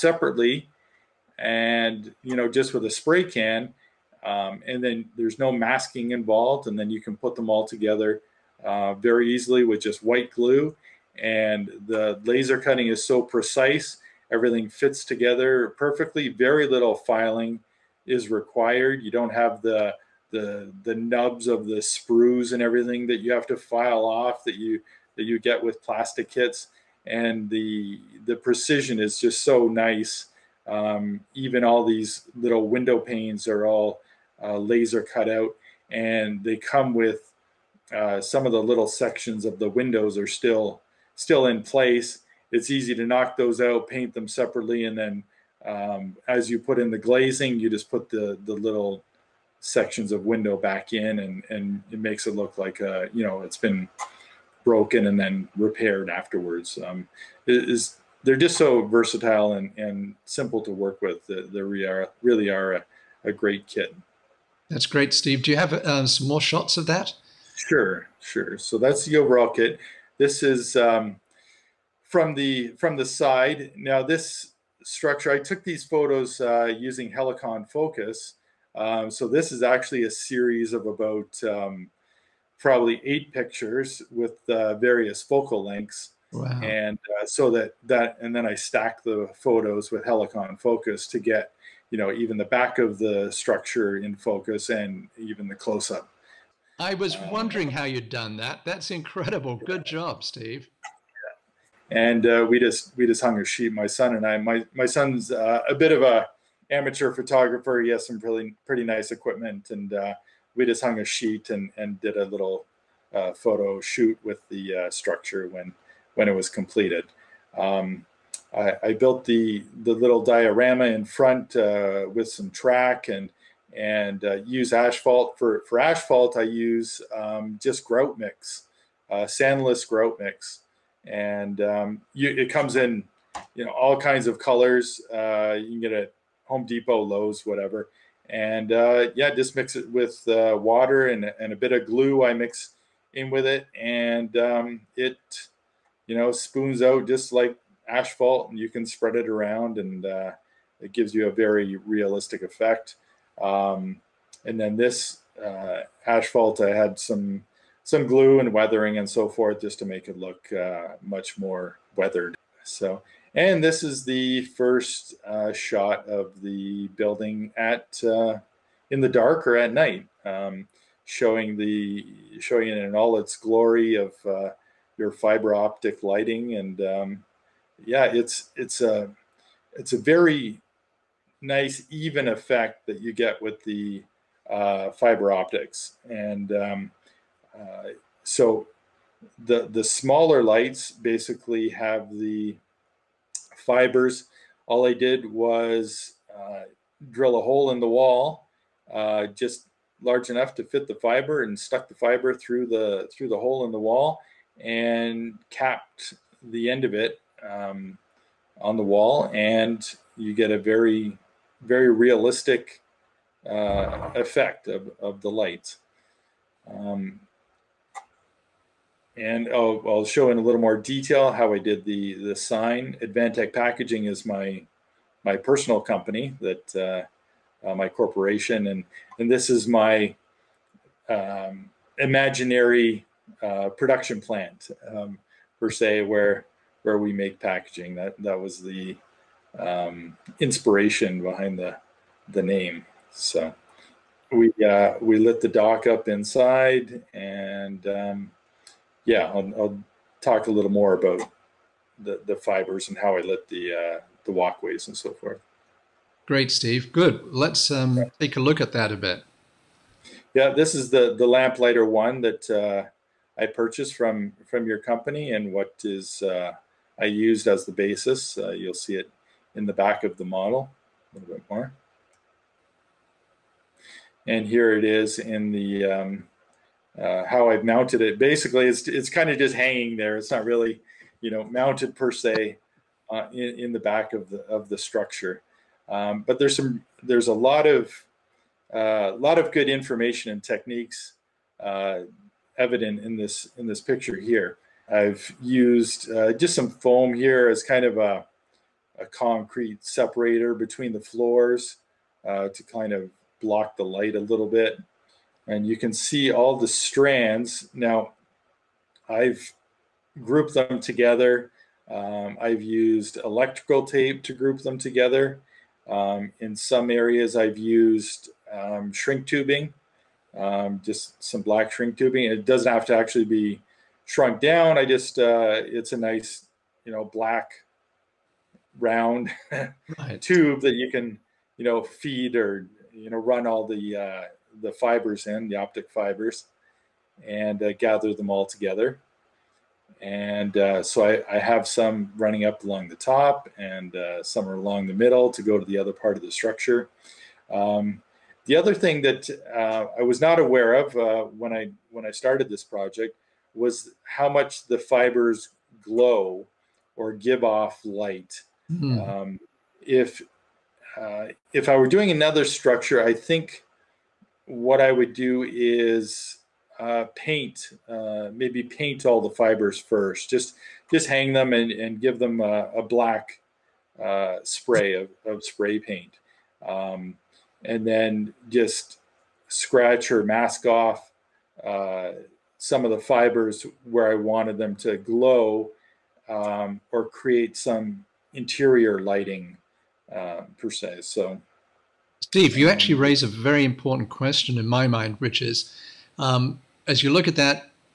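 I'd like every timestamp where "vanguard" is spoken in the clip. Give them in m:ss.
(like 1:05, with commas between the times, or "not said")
not said.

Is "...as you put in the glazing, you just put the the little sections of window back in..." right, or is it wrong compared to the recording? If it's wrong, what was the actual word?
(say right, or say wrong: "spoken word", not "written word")
right.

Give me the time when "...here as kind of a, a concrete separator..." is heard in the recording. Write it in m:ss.
4:57.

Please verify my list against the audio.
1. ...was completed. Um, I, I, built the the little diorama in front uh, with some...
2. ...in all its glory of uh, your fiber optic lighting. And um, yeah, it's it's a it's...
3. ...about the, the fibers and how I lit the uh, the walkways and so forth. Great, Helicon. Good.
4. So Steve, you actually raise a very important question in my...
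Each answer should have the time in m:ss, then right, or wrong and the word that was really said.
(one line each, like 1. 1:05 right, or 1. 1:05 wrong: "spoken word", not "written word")
1. 1:56 right
2. 2:52 right
3. 4:10 wrong: "Steve", not "Helicon"
4. 6:31 right.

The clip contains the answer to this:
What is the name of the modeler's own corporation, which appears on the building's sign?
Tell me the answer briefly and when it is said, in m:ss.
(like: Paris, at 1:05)
Advantech Packaging, at 3:43.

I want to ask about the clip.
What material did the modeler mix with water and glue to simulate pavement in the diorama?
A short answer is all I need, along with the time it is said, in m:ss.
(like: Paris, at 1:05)
sandless grout mix, at 2:09.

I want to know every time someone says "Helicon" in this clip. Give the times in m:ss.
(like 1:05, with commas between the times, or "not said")
1:17, 1:30.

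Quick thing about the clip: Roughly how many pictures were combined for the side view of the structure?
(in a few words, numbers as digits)
8.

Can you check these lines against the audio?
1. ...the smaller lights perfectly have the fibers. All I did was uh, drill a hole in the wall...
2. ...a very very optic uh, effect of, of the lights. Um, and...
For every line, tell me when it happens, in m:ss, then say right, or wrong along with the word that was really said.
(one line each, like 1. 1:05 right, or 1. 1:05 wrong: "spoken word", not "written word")
1. 3:09 wrong: "basically", not "perfectly"
2. 3:30 wrong: "realistic", not "optic".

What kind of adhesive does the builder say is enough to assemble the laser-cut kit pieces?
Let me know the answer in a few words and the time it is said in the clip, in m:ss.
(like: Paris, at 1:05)
white glue, at 0:10.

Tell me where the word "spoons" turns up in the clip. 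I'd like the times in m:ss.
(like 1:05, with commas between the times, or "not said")
2:26.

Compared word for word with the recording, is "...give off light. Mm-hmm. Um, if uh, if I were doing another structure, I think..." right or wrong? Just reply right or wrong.
right.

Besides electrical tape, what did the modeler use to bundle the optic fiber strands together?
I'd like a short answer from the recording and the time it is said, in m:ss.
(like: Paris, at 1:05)
black shrink tubing, at 5:21.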